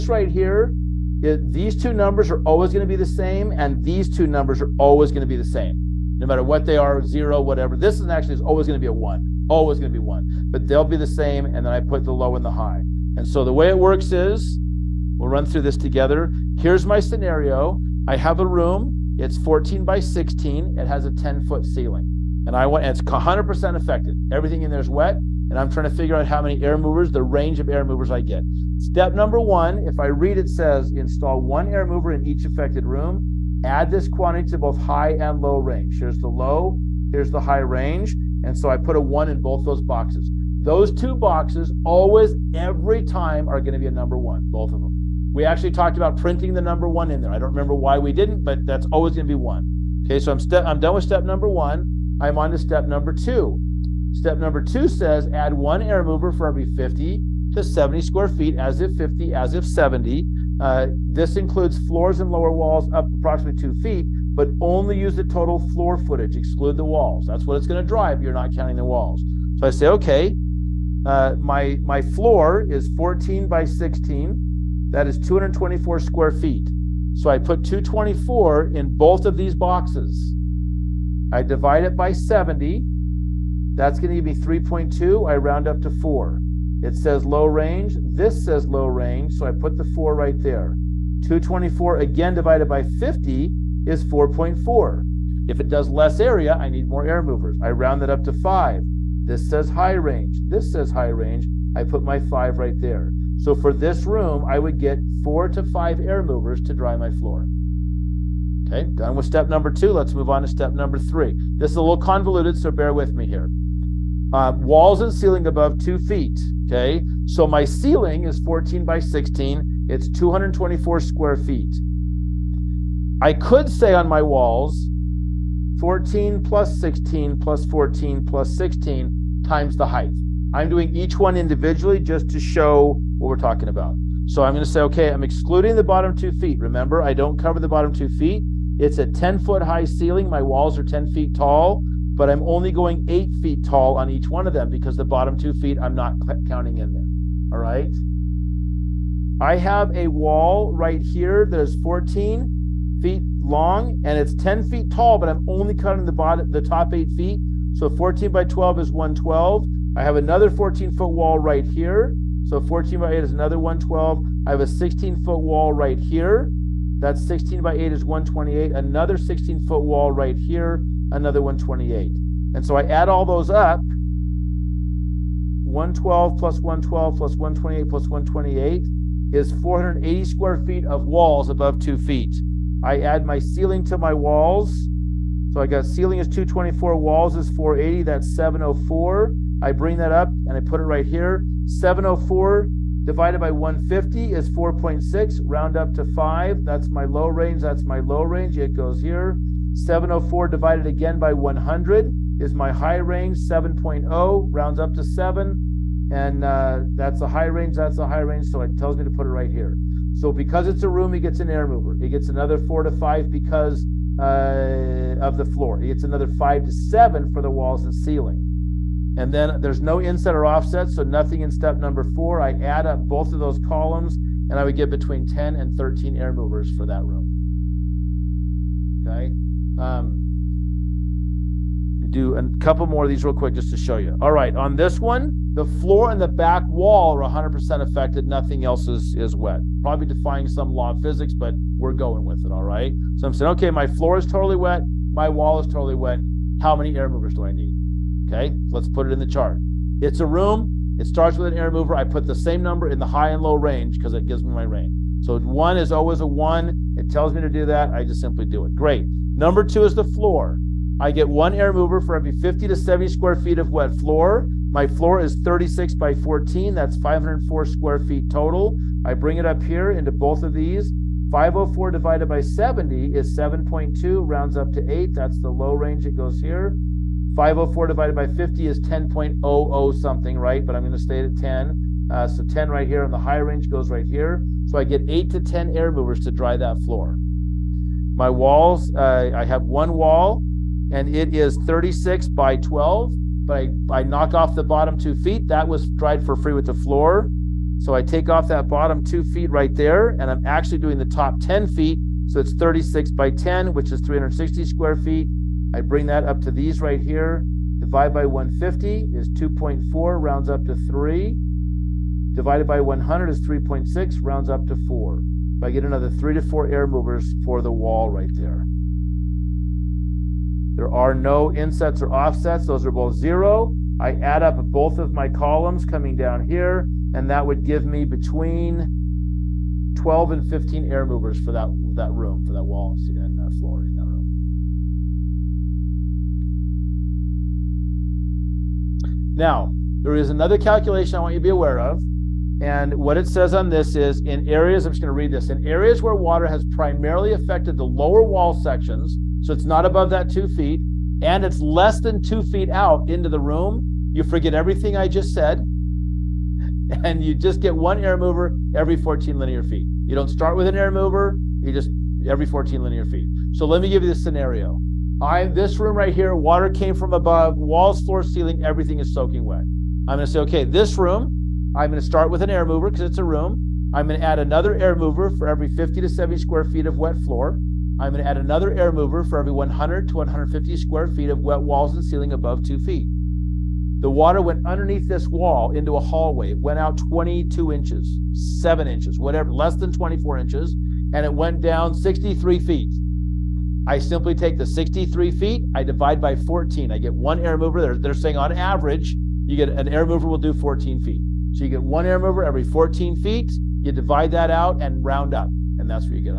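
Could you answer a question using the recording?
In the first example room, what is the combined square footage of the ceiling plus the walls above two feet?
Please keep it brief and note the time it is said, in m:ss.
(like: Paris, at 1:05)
704, at 3:08.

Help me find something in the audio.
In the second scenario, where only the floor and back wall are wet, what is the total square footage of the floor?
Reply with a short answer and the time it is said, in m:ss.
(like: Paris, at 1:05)
504, at 4:26.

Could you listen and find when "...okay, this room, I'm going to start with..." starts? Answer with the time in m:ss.
6:10.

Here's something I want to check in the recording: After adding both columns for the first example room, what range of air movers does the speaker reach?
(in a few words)
10 to 13.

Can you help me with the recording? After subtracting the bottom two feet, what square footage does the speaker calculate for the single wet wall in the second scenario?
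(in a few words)
360.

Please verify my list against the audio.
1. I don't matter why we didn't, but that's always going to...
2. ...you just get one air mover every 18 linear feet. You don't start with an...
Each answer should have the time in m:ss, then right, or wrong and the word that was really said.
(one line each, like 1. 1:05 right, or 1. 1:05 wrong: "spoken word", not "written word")
1. 0:47 wrong: "remember", not "matter"
2. 5:57 wrong: "14", not "18".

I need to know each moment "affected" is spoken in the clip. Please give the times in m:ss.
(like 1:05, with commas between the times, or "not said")
0:23, 0:32, 3:57, 5:47.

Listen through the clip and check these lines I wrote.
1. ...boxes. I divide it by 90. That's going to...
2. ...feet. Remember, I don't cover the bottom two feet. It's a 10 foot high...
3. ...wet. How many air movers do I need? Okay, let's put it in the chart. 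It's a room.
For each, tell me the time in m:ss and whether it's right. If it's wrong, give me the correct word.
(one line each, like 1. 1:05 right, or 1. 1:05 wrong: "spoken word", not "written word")
1. 1:19 wrong: "70", not "90"
2. 2:16 right
3. 4:05 right.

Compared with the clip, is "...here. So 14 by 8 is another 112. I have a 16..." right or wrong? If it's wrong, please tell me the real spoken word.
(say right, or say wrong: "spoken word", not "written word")
right.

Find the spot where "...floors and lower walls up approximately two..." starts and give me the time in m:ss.
1:01.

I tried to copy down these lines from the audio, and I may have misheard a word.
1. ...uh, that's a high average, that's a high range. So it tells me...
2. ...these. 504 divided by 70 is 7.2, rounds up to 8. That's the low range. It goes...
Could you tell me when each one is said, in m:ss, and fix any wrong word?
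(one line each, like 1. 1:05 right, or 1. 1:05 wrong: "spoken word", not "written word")
1. 3:26 wrong: "range", not "average"
2. 4:30 right.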